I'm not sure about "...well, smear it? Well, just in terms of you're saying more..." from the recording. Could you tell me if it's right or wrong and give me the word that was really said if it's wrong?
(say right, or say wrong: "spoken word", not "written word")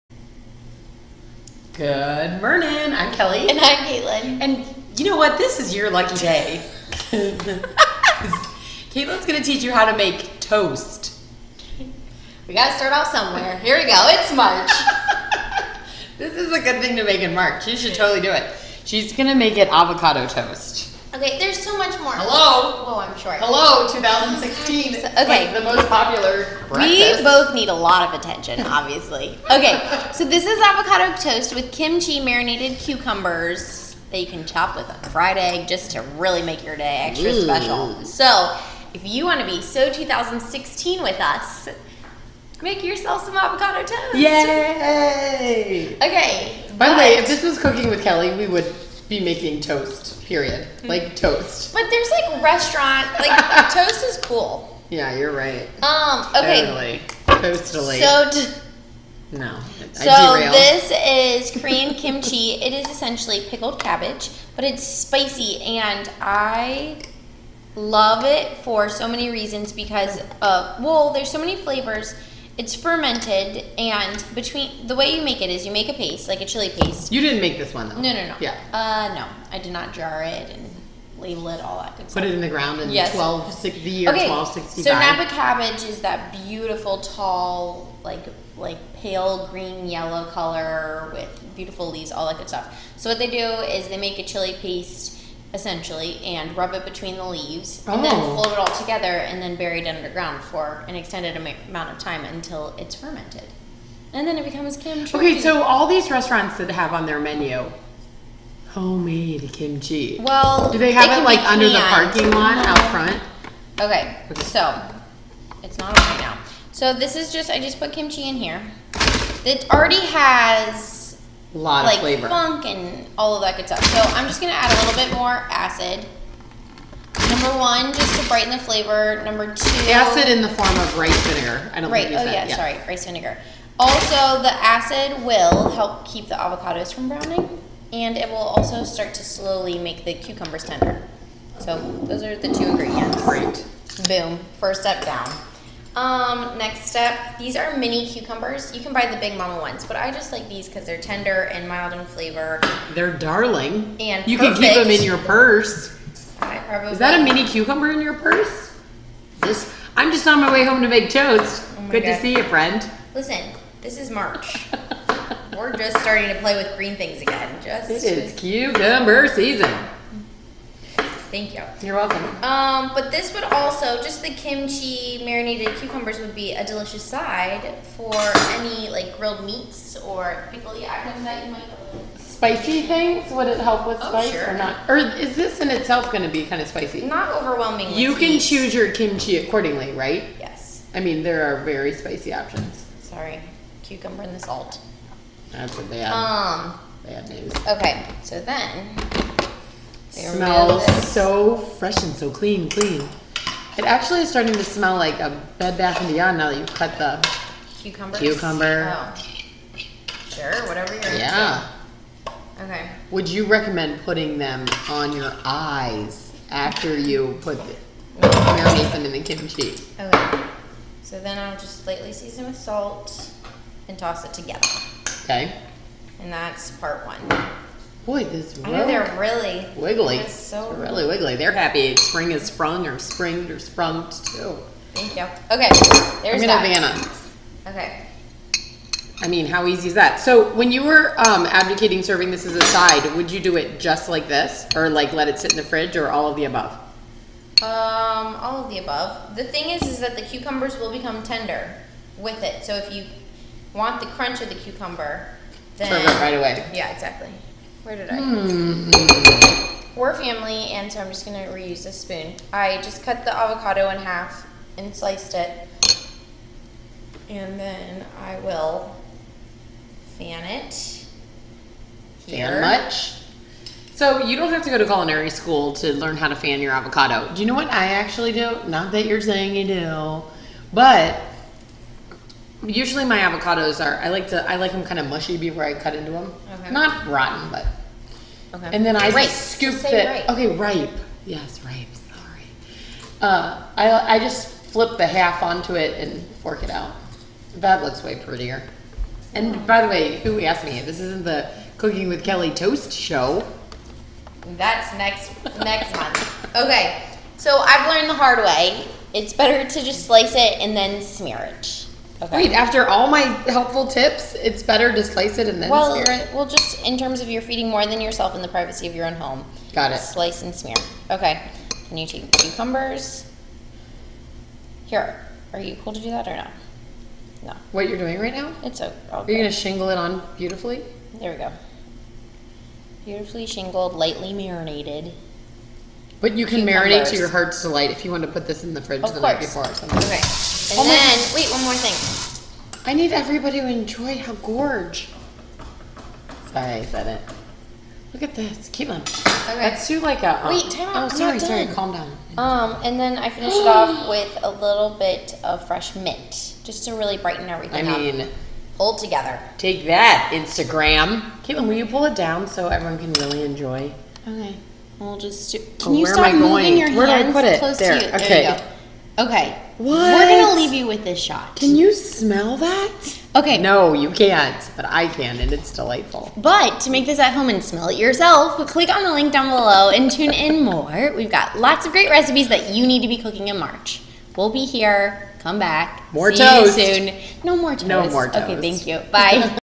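wrong: "feeding", not "saying".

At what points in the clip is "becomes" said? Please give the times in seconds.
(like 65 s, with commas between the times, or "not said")
104 s, 250 s.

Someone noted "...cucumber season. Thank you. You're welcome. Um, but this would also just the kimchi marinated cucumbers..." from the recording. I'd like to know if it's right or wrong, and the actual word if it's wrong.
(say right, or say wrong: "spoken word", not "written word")
right.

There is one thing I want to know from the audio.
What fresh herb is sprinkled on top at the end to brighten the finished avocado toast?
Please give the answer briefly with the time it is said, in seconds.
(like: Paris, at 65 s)
mint, at 355 s.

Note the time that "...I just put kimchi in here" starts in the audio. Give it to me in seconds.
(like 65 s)
117 s.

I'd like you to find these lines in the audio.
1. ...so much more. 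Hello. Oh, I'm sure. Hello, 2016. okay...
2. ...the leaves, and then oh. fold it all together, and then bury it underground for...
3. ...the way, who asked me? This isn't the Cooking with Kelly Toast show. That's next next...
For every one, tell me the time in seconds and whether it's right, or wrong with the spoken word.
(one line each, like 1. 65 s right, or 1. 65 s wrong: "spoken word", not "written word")
1. 21 s right
2. 97 s right
3. 299 s right.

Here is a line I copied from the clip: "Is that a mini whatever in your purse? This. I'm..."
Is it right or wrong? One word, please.
wrong.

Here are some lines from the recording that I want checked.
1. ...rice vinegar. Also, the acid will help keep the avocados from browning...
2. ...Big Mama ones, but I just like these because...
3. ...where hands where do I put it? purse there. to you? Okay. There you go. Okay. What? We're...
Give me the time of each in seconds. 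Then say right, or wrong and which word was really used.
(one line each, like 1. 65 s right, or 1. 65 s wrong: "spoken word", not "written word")
1. 132 s right
2. 149 s right
3. 366 s wrong: "close", not "purse".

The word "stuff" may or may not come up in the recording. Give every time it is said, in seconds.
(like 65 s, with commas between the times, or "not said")
82 s, 92 s, 123 s.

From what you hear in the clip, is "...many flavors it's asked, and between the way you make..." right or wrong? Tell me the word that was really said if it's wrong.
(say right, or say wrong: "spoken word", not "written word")
wrong: "fermented", not "asked".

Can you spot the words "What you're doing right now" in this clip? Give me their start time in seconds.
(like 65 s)
327 s.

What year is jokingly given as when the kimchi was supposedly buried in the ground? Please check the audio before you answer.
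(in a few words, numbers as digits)
1265.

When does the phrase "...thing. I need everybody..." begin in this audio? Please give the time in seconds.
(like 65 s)
341 s.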